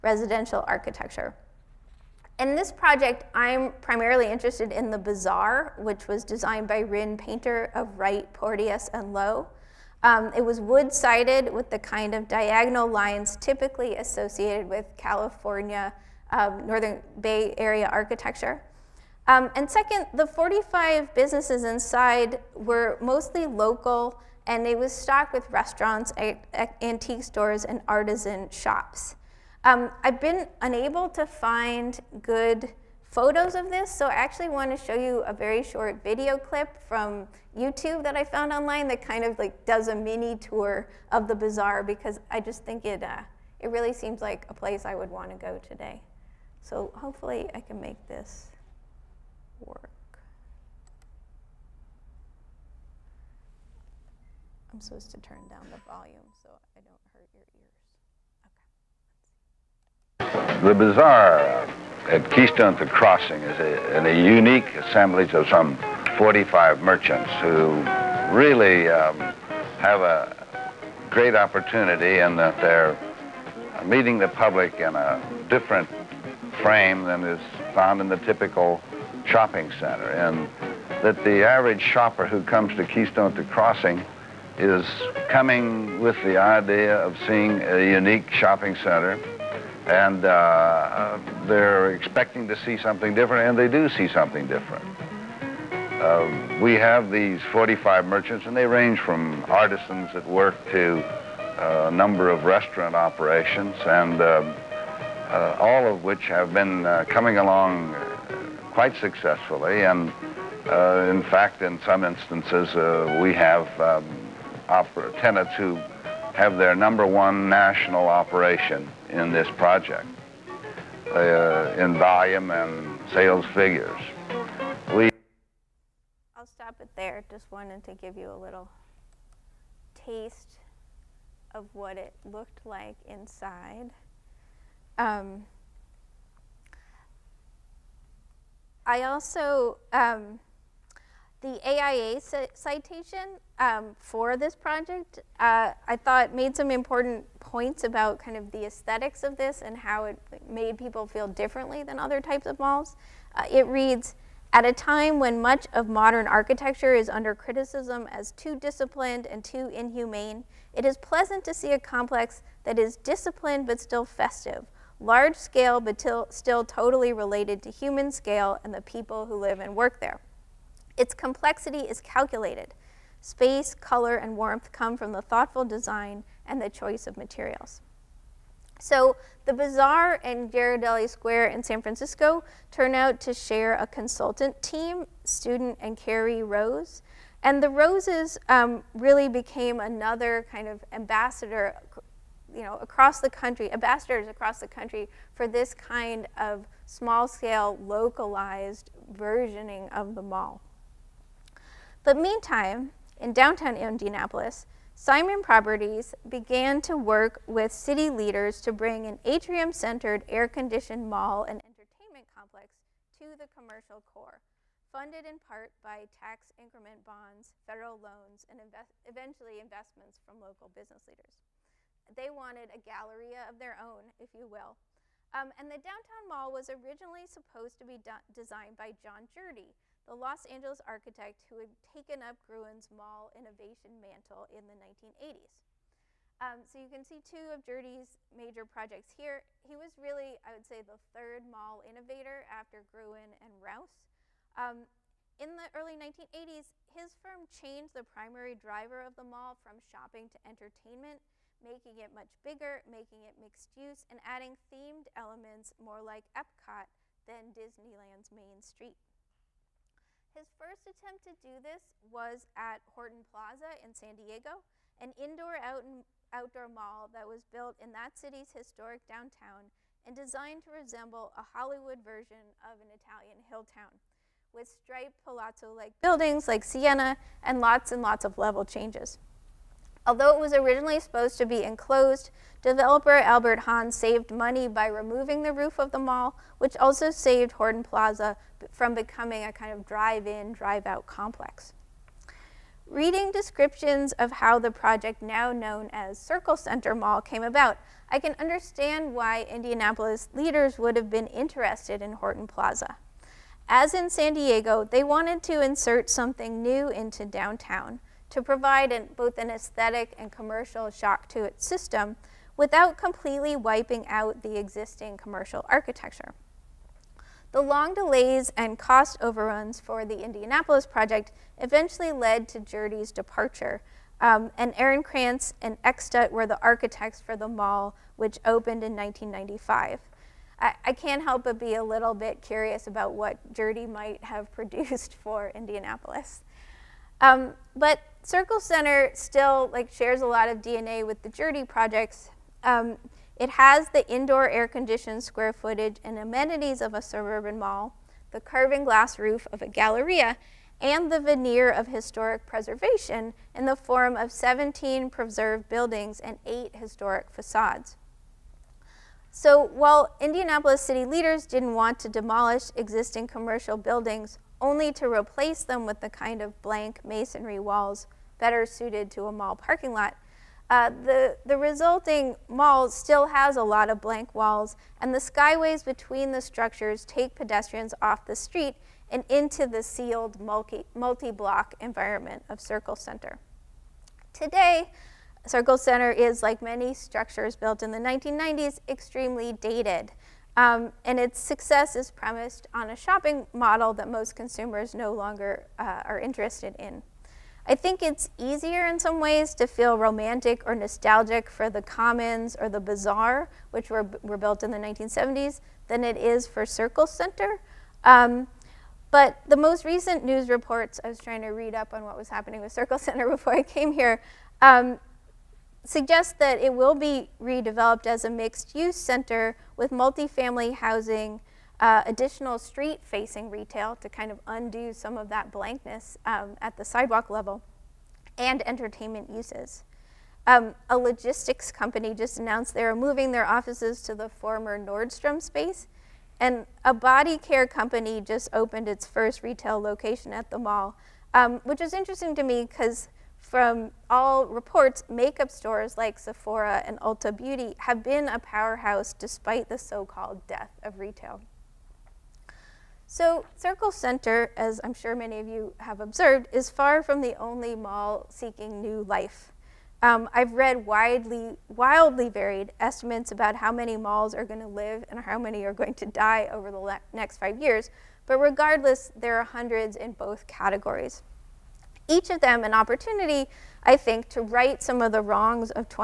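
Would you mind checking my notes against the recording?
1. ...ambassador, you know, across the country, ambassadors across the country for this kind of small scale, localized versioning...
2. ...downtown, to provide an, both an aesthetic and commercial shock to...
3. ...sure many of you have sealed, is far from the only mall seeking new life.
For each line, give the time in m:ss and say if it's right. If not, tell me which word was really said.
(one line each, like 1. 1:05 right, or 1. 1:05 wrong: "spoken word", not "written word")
1. 3:10 right
2. 5:07 right
3. 7:34 wrong: "observed", not "sealed".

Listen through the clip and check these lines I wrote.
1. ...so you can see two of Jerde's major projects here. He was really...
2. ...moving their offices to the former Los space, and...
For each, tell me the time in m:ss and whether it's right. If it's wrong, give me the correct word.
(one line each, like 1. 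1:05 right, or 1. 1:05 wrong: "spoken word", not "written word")
1. 3:56 right
2. 7:12 wrong: "Nordstrom", not "Los".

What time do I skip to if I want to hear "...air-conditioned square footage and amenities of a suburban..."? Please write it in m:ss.
5:44.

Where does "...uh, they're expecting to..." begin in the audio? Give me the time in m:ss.
1:30.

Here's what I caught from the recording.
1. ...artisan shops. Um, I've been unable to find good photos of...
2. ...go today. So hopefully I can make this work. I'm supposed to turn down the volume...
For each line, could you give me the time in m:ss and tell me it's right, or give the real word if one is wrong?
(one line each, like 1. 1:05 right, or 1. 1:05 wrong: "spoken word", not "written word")
1. 0:27 right
2. 0:45 right.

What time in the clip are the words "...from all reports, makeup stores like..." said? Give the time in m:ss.
7:23.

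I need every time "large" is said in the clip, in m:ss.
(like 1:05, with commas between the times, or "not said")
2:44.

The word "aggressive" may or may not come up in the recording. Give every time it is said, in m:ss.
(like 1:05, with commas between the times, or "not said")
not said.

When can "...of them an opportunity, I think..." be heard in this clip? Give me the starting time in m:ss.
7:52.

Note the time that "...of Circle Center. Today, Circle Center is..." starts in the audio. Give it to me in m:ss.
6:22.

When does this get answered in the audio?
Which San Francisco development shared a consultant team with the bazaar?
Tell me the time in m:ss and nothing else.
3:00.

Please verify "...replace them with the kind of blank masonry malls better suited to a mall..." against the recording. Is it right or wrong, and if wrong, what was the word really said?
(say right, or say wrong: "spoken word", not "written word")
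wrong: "walls", not "malls".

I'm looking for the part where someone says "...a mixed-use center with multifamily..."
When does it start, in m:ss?
6:58.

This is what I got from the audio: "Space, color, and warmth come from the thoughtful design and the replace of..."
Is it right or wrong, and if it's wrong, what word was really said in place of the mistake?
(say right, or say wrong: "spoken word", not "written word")
wrong: "choice", not "replace".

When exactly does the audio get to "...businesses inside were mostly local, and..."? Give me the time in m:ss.
0:21.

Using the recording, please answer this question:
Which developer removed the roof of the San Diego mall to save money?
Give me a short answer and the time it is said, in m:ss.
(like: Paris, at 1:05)
Albert Hahn, at 4:43.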